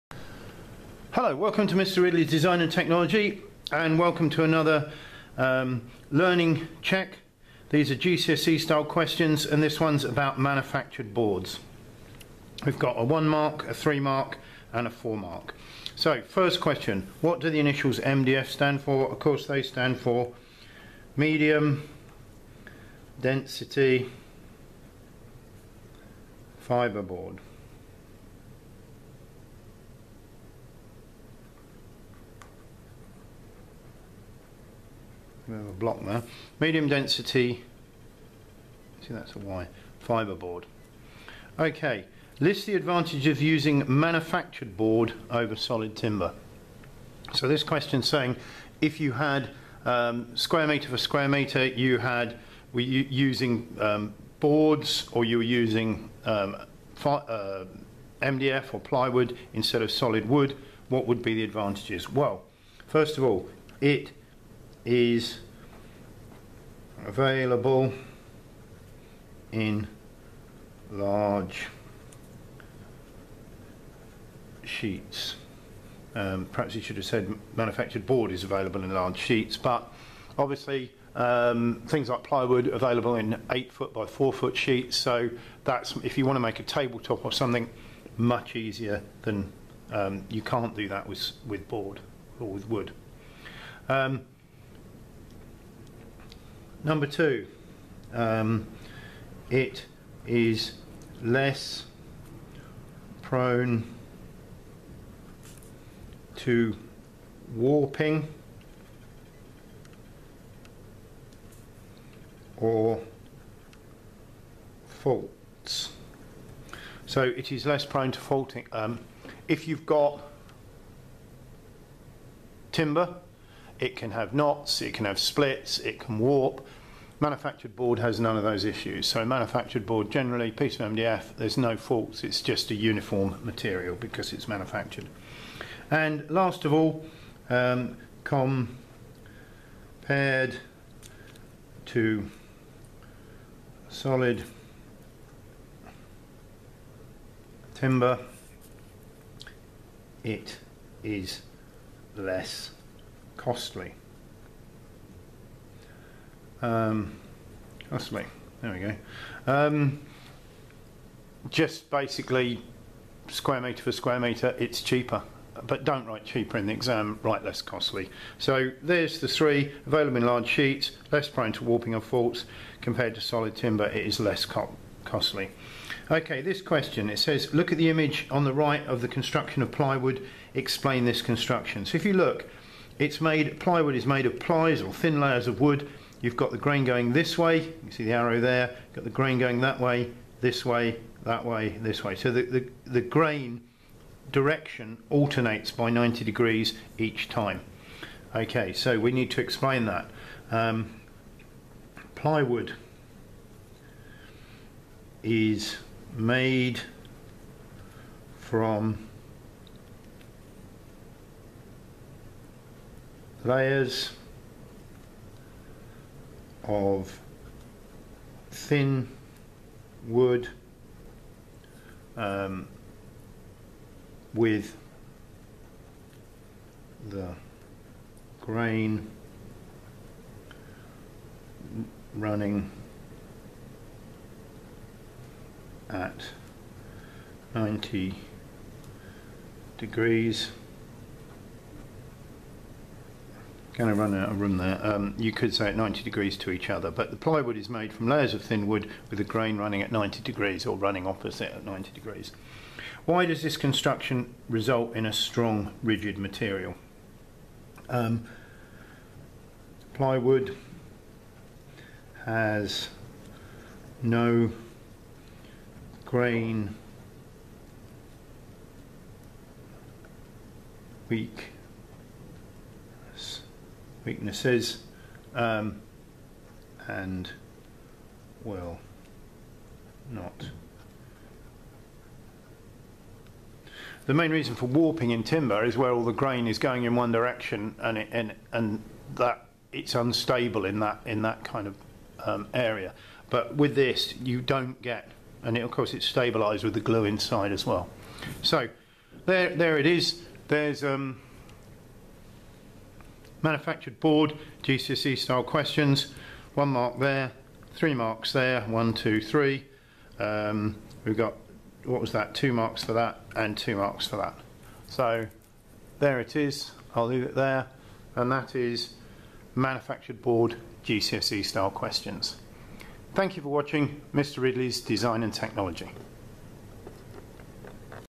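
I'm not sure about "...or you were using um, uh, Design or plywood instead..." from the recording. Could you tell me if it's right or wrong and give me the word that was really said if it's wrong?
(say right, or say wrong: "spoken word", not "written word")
wrong: "MDF", not "Design".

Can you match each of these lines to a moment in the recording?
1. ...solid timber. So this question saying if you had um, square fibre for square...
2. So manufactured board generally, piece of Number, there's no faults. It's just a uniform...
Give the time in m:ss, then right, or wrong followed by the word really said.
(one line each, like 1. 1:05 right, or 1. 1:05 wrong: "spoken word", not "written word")
1. 0:45 wrong: "metre", not "fibre"
2. 2:09 wrong: "MDF", not "Number".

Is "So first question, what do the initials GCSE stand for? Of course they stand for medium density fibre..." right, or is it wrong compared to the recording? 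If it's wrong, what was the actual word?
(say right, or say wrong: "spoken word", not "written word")
wrong: "MDF", not "GCSE".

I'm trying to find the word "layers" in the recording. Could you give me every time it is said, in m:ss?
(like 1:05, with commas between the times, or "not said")
3:05, 3:33, 4:08.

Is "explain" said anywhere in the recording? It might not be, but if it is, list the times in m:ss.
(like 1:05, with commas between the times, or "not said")
3:00, 3:19.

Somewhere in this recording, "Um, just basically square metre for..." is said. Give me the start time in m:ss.
2:39.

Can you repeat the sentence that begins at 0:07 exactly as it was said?
These are GCSE style questions and this one's about manufactured boards.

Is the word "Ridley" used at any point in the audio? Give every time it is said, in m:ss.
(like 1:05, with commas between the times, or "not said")
0:02, 5:24.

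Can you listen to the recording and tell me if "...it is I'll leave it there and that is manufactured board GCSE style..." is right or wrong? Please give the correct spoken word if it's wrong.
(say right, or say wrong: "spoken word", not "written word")
right.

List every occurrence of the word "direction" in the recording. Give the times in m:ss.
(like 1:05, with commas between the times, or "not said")
3:14, 4:47.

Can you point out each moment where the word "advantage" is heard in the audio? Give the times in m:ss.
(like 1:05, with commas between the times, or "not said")
0:42, 1:01.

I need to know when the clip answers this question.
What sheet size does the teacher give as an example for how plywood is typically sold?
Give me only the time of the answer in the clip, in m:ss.
1:23.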